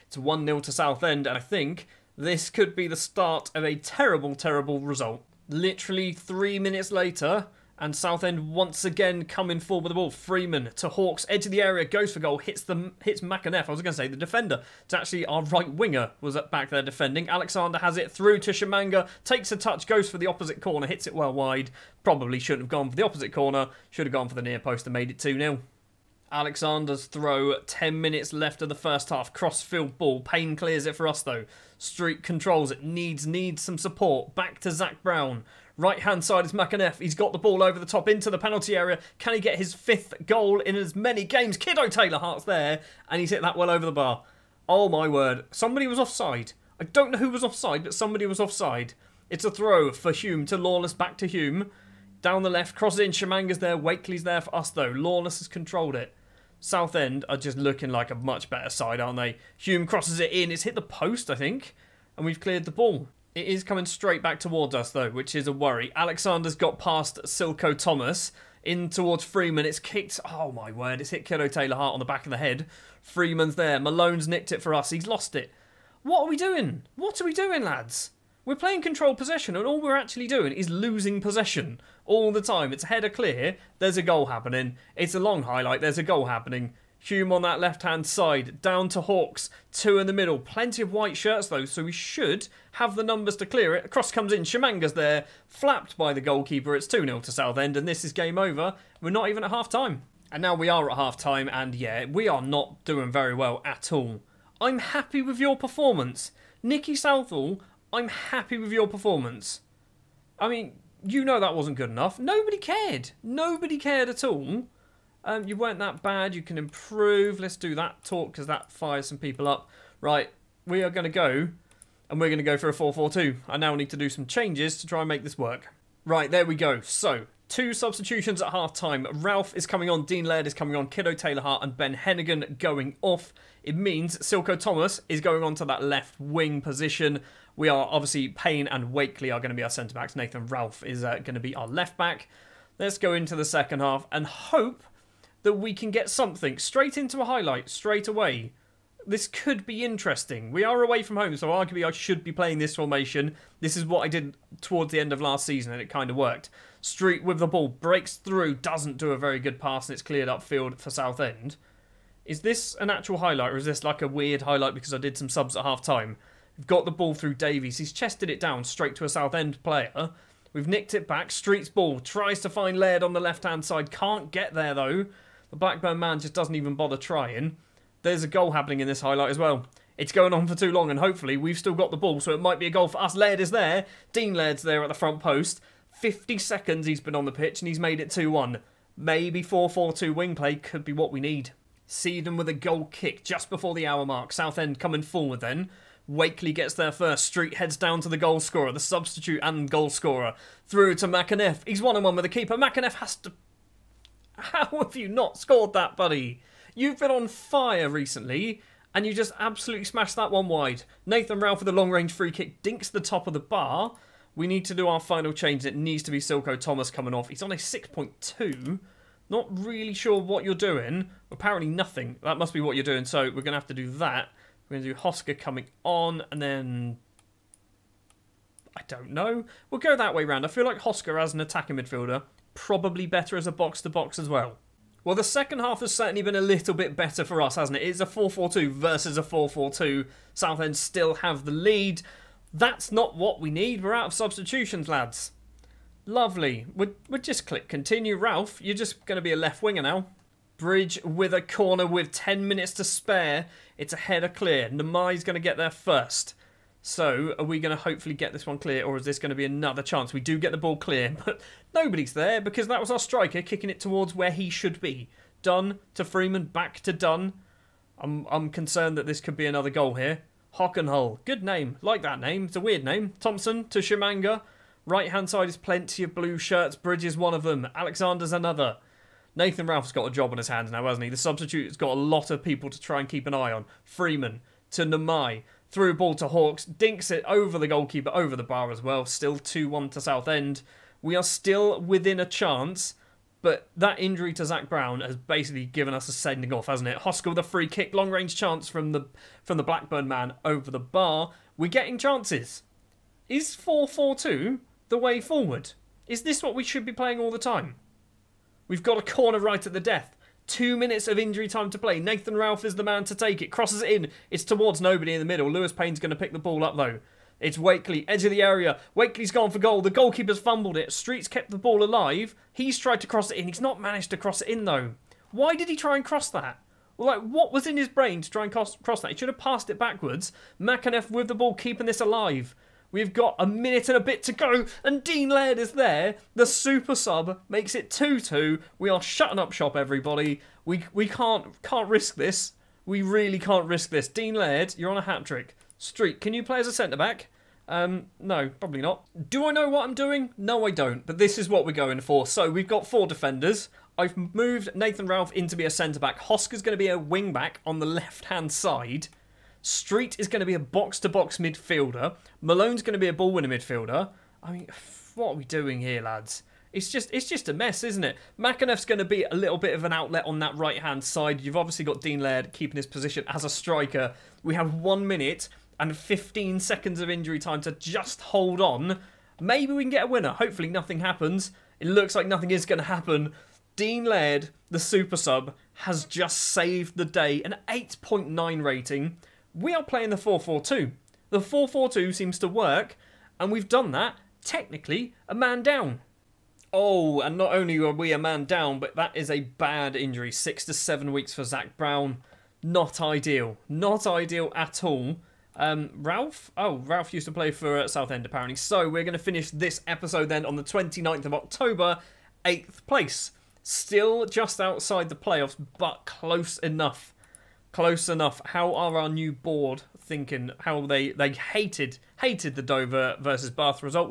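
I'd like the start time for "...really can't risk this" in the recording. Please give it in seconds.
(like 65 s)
343 s.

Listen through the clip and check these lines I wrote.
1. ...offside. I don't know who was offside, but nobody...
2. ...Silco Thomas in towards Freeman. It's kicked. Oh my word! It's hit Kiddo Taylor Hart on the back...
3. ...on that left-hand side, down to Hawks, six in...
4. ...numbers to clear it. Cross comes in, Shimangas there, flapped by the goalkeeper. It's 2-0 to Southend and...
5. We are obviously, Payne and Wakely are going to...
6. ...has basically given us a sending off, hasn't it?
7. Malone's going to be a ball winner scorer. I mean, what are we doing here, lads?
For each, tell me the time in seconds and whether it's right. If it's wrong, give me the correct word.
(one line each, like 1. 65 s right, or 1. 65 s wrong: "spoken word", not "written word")
1. 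45 s wrong: "somebody", not "nobody"
2. 67 s right
3. 87 s wrong: "two", not "six"
4. 93 s right
5. 137 s right
6. 294 s right
7. 362 s wrong: "midfielder", not "scorer".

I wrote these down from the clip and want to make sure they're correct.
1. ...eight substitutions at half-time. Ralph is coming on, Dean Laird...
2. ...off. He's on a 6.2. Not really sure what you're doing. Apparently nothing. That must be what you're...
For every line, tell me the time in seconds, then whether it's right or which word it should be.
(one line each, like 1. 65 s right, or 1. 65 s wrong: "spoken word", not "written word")
1. 127 s wrong: "two", not "eight"
2. 217 s right.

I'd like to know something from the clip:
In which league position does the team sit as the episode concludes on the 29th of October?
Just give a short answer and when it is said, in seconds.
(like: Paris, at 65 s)
8th, at 412 s.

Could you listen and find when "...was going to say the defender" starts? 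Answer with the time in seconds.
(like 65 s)
13 s.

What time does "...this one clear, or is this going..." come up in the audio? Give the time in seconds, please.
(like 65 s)
258 s.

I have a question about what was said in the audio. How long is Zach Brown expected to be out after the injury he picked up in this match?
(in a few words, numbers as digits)
Six to seven weeks.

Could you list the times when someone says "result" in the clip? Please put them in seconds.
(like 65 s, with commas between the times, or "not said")
4 s.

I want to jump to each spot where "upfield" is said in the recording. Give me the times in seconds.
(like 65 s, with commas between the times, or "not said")
160 s.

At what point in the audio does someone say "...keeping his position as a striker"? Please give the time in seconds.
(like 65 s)
372 s.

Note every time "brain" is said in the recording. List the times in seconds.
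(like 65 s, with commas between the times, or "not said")
327 s.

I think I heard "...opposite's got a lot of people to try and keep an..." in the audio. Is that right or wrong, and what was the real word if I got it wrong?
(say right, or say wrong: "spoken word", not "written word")
wrong: "substitute", not "opposite".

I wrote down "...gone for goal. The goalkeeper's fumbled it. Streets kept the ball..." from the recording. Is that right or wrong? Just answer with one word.
right.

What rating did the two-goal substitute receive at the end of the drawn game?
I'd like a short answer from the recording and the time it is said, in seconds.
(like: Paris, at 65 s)
8.9, at 387 s.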